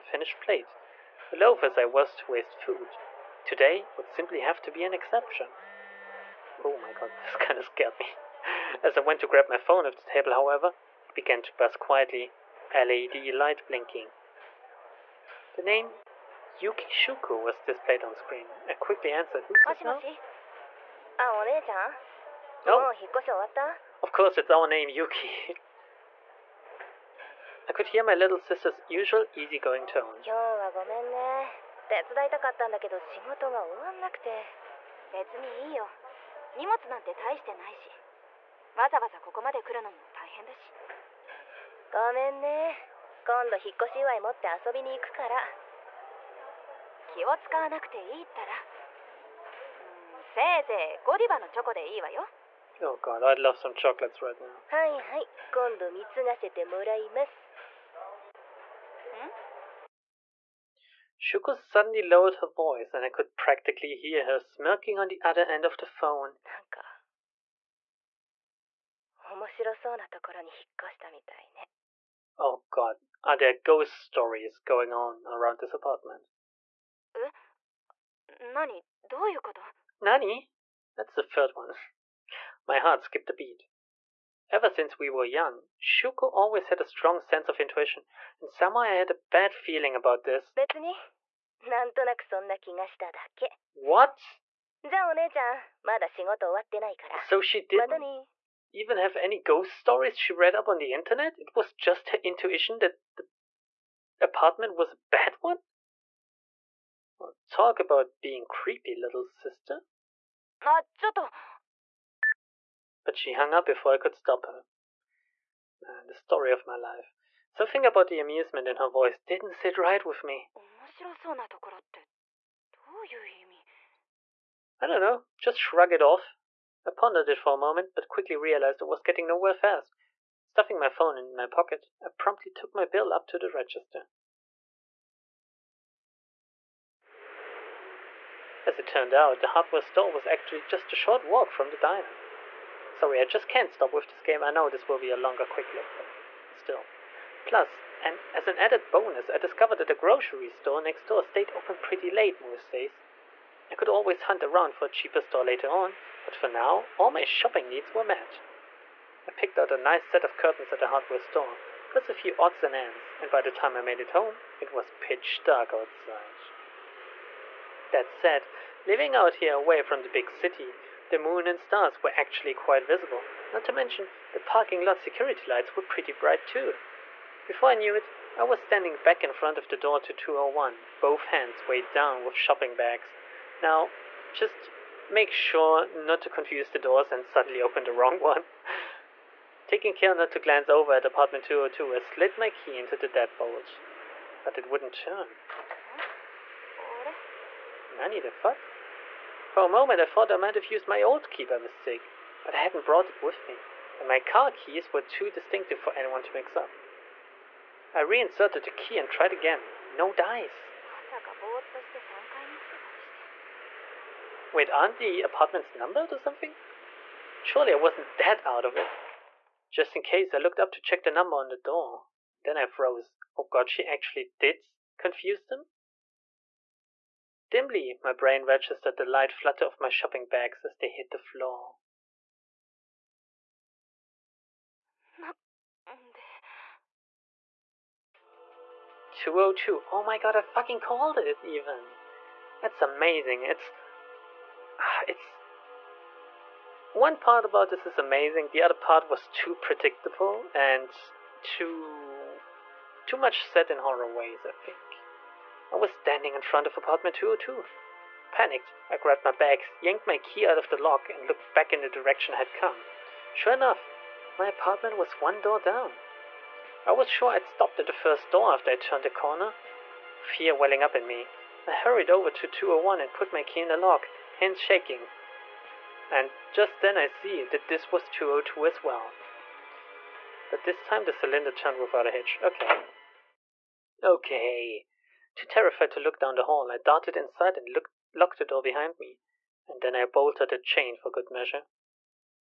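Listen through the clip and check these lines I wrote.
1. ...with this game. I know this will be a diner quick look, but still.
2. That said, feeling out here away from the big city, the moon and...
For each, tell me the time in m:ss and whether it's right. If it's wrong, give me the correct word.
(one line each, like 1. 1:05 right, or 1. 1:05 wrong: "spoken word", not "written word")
1. 2:23 wrong: "longer", not "diner"
2. 2:47 wrong: "living", not "feeling".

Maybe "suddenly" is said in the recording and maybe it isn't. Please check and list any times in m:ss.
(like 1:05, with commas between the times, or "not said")
1:01, 3:07.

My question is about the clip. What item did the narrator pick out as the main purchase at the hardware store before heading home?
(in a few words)
curtains.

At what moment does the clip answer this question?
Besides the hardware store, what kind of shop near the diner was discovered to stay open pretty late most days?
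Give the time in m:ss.
2:29.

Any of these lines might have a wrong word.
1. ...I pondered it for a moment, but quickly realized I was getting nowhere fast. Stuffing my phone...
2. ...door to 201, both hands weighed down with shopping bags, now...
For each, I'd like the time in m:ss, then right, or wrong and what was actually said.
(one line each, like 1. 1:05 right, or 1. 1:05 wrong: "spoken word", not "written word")
1. 2:06 right
2. 2:59 right.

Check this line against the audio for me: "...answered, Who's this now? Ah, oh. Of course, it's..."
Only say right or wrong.
right.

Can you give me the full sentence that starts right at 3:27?
I reinserted the key and tried again.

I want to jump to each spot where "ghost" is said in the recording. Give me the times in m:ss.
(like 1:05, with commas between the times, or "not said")
1:13, 1:39.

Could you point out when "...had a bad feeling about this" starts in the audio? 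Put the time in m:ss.
1:28.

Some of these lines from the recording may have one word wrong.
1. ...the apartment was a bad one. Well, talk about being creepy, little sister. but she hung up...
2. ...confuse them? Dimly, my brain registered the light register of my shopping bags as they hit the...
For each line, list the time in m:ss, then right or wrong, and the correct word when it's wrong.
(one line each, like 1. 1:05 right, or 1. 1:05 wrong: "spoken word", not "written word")
1. 1:43 right
2. 3:44 wrong: "flutter", not "register".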